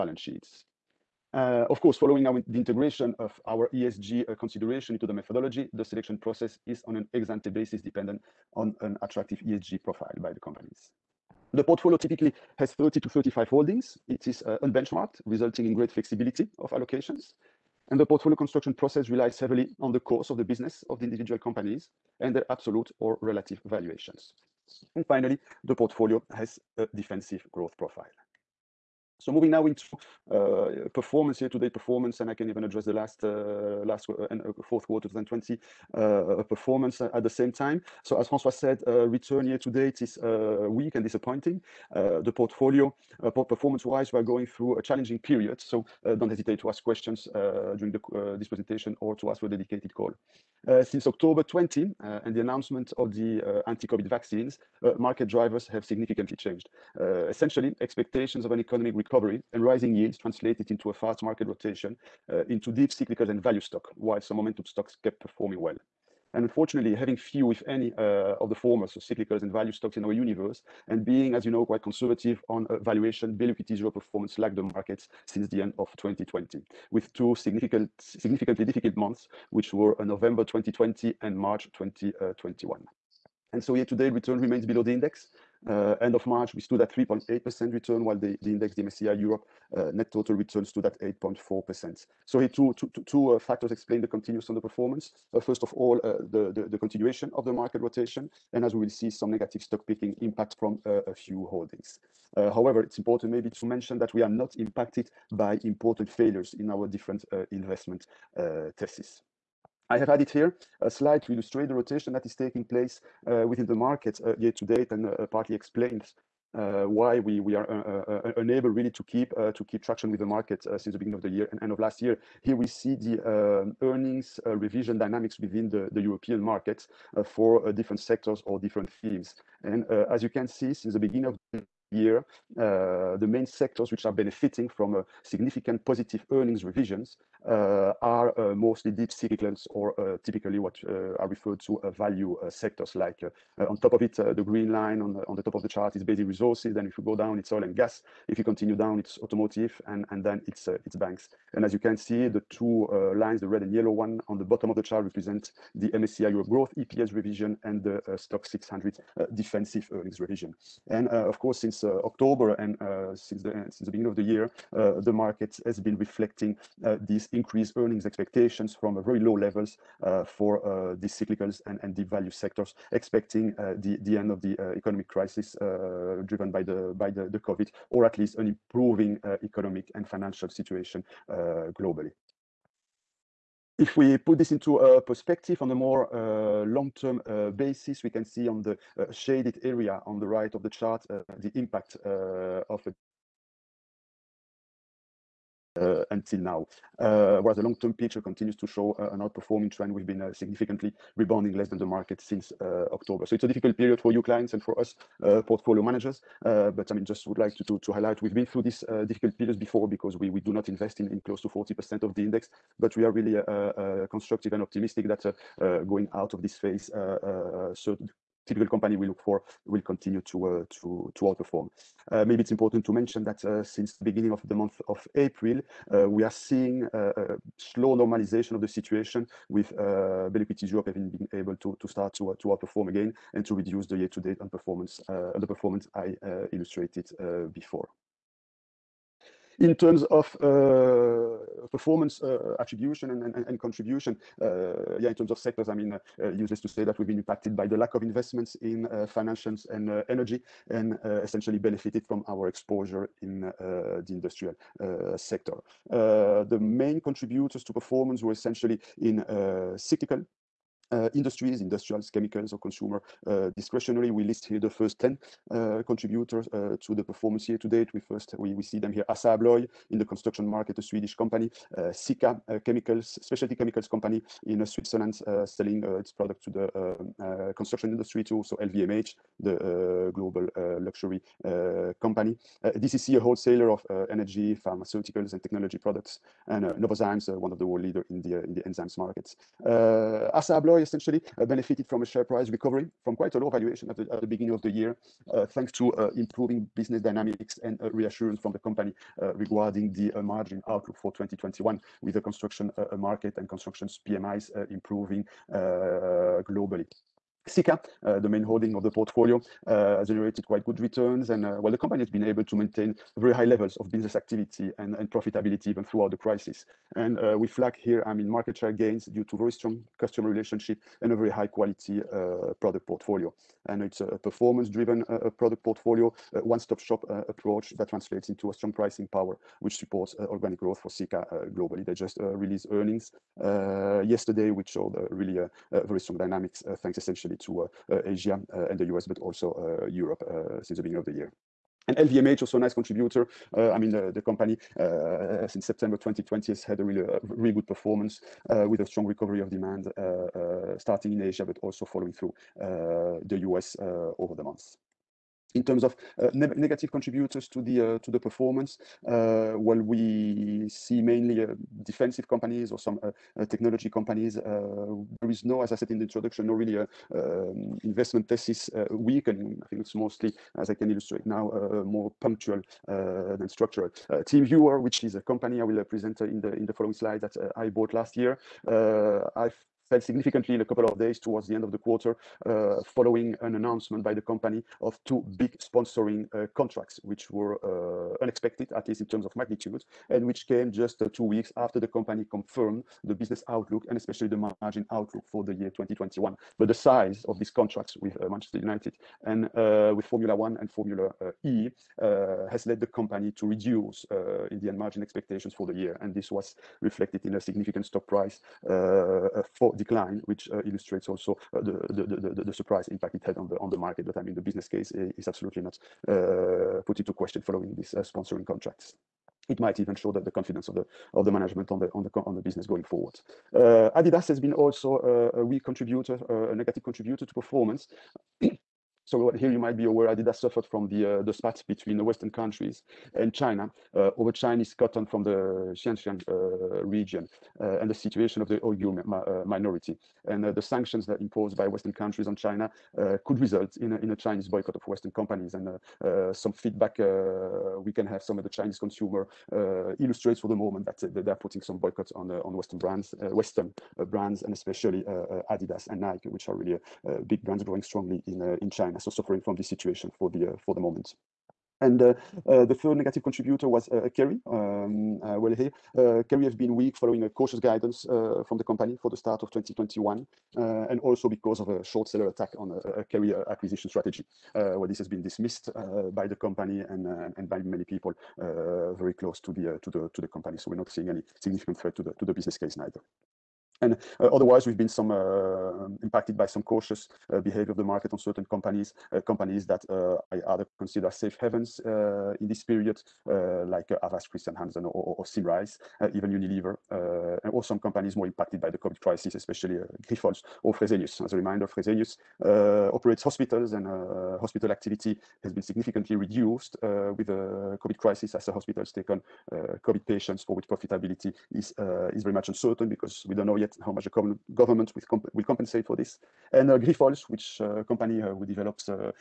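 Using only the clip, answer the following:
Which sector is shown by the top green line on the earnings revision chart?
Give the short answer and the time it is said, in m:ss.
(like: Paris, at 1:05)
Basic resources, at 2:26.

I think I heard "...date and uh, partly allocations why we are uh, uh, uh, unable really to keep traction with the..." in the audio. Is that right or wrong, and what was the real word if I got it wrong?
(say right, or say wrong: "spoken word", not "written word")
wrong: "explains", not "allocations".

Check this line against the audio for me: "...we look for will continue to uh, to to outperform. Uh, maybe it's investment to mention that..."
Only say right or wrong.
wrong.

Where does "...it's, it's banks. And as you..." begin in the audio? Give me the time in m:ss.
2:30.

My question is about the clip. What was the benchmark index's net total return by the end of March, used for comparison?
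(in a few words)
8.4%.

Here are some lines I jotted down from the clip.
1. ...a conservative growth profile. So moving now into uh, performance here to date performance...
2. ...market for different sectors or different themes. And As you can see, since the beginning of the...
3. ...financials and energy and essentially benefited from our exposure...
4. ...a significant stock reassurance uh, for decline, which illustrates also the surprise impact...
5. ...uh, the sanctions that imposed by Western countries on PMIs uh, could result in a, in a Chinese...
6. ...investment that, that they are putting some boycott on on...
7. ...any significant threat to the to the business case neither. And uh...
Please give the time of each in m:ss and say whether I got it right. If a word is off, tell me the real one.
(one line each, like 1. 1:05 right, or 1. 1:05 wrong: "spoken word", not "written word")
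1. 0:26 wrong: "defensive", not "conservative"
2. 2:06 right
3. 4:09 right
4. 6:47 wrong: "price", not "reassurance"
5. 7:20 wrong: "China", not "PMIs"
6. 7:30 wrong: "moment", not "investment"
7. 8:01 right.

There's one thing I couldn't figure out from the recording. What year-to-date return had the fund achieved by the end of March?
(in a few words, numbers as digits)
3.8%.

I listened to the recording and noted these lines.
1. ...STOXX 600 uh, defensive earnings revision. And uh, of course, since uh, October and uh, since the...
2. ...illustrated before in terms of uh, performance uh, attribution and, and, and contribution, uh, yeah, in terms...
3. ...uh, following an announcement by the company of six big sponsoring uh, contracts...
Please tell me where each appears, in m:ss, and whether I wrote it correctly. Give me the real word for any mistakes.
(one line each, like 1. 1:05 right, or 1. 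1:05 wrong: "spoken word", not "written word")
1. 2:38 right
2. 3:56 right
3. 6:22 wrong: "two", not "six".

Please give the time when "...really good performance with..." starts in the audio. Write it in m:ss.
5:47.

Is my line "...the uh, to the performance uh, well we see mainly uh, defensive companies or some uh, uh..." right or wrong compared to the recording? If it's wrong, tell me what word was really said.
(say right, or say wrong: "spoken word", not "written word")
right.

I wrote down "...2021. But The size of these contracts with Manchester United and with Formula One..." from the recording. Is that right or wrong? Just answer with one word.
right.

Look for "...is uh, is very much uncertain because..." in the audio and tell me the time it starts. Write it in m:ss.
8:31.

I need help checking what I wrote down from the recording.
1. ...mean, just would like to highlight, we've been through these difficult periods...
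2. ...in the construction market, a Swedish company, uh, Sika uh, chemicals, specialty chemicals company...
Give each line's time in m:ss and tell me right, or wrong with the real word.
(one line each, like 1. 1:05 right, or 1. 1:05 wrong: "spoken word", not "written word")
1. 3:26 right
2. 4:29 right.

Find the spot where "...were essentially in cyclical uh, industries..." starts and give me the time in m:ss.
4:18.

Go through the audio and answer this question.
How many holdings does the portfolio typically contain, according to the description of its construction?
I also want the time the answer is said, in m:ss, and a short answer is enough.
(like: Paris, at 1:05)
30-35, at 0:12.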